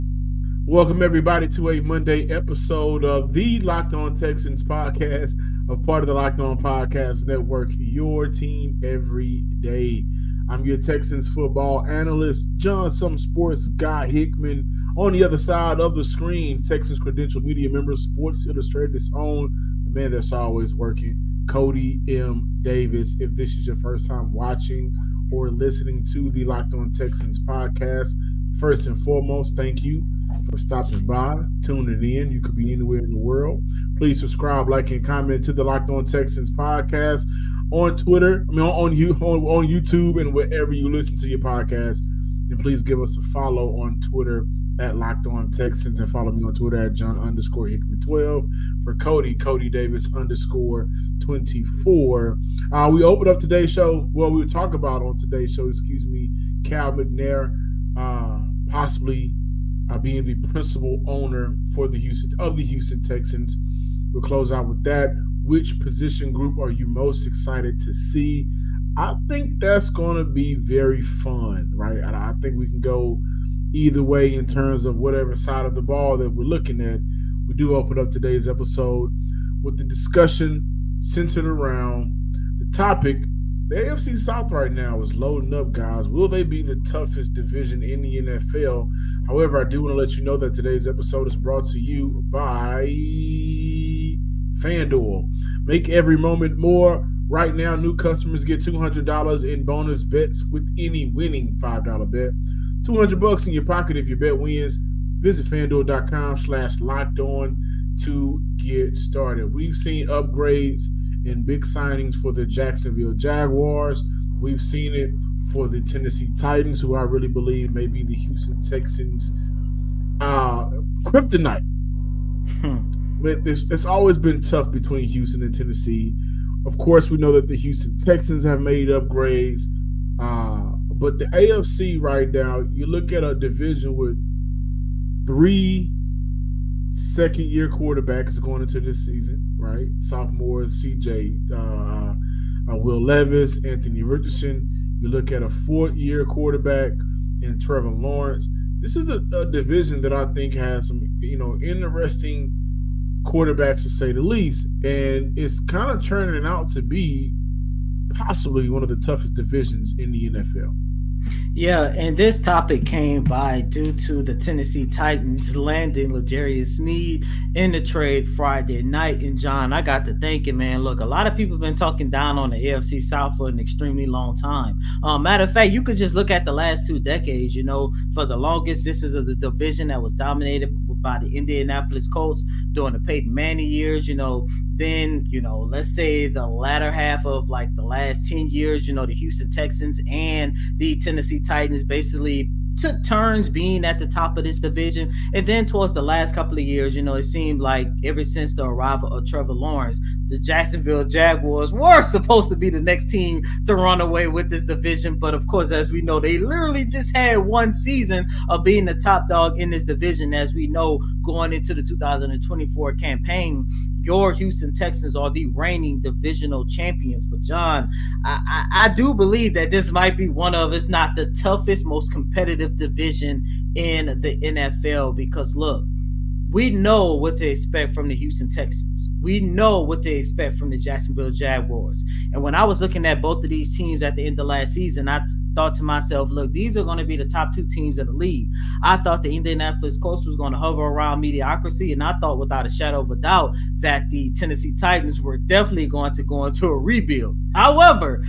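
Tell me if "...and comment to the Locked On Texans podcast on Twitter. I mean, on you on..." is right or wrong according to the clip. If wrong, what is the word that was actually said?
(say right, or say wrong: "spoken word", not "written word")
right.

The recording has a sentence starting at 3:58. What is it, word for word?
I thought the Indianapolis Colts was going to hover around mediocrity.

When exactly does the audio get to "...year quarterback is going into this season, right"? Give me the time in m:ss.
2:17.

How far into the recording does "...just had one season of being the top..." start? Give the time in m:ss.
3:26.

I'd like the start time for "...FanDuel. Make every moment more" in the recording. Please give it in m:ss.
1:34.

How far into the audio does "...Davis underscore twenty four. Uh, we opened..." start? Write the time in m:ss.
0:49.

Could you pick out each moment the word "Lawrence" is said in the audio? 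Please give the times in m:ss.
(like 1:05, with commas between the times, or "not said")
2:27, 3:19.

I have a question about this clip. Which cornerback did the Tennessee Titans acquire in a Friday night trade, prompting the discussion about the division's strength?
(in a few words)
L'Jarius Sneed.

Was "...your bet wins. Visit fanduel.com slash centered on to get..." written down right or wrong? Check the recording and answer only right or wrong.
wrong.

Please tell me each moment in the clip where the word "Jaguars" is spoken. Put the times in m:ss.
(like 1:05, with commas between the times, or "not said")
1:53, 3:21, 3:51.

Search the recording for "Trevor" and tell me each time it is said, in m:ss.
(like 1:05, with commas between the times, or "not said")
2:27, 3:19.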